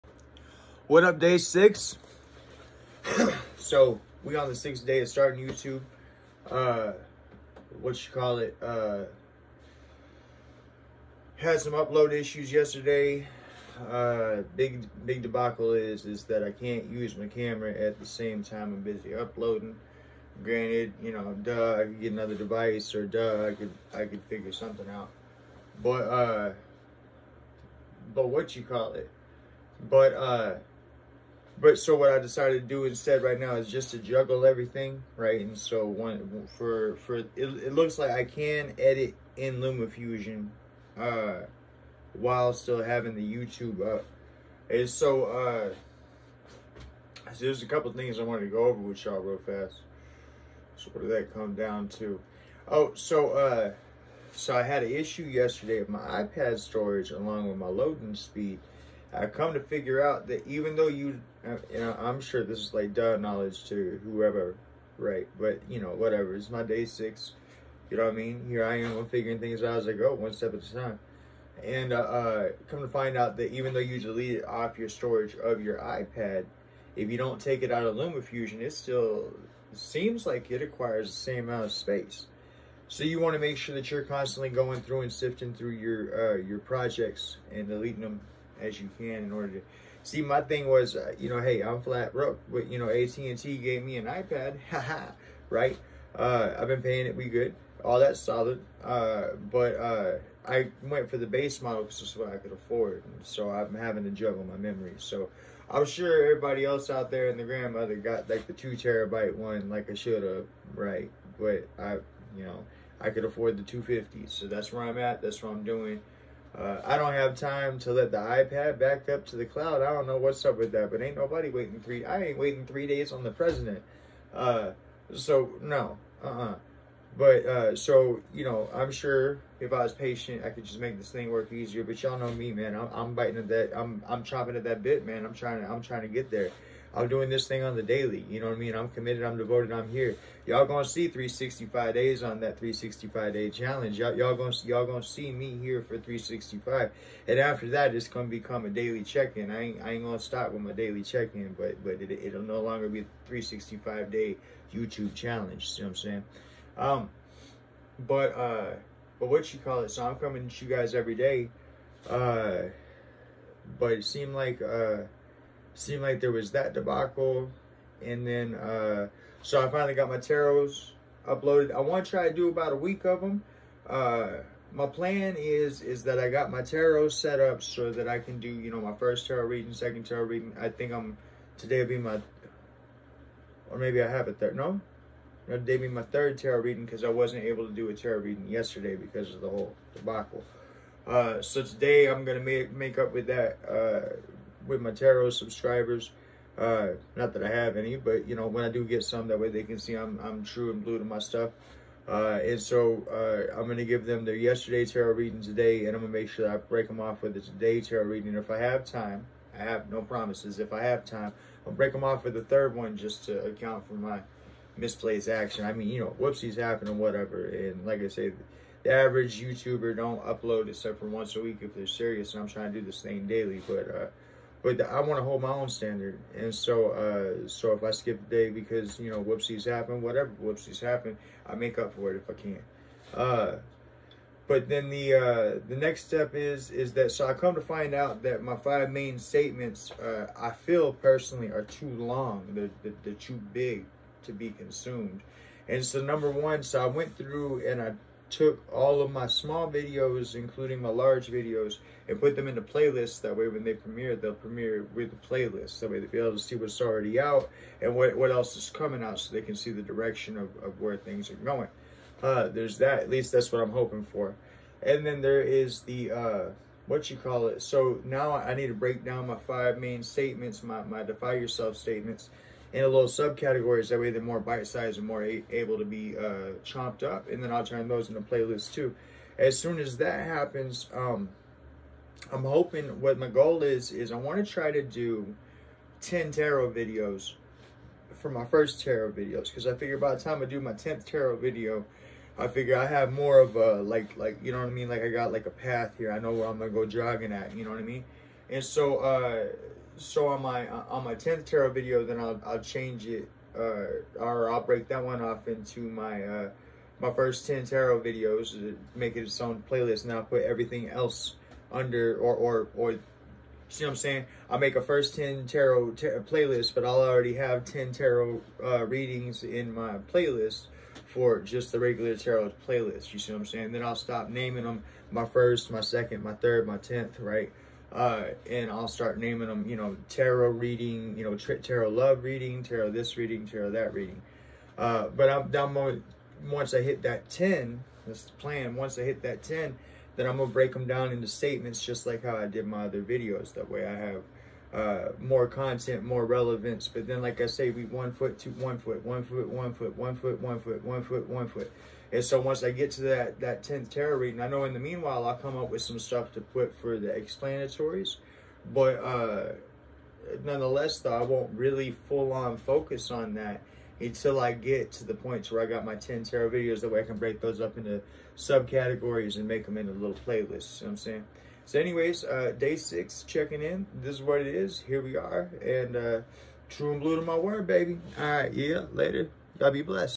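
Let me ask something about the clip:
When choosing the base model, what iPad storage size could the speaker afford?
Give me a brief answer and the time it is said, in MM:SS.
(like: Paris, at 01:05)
250, at 01:53.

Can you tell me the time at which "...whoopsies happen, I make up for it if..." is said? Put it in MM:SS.
03:50.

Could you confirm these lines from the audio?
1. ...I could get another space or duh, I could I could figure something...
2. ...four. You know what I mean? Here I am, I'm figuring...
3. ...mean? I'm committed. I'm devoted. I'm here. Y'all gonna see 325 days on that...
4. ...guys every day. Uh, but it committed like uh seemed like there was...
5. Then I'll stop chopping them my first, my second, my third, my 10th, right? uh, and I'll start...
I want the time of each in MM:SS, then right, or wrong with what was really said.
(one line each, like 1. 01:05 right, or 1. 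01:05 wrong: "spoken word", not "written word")
1. 00:21 wrong: "device", not "space"
2. 01:06 wrong: "six", not "four"
3. 02:18 wrong: "365", not "325"
4. 02:40 wrong: "seemed", not "committed"
5. 05:23 wrong: "naming", not "chopping".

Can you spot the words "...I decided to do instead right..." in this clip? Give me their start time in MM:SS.
00:32.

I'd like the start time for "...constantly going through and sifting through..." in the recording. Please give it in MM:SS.
01:24.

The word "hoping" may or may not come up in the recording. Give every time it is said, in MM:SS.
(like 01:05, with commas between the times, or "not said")
04:23, 04:42.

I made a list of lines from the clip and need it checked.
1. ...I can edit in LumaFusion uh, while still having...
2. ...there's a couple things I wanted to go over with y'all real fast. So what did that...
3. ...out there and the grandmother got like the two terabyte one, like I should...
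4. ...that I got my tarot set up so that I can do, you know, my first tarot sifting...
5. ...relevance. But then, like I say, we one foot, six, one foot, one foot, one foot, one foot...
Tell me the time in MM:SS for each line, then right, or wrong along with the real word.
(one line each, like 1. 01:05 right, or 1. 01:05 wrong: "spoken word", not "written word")
1. 00:38 right
2. 00:47 right
3. 01:46 right
4. 02:56 wrong: "reading", not "sifting"
5. 05:46 wrong: "two", not "six".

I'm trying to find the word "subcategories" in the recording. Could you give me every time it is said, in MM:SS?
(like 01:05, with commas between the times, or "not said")
04:33, 06:08.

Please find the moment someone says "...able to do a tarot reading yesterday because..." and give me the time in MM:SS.
03:07.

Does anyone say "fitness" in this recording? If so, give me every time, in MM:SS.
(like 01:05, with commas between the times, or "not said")
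not said.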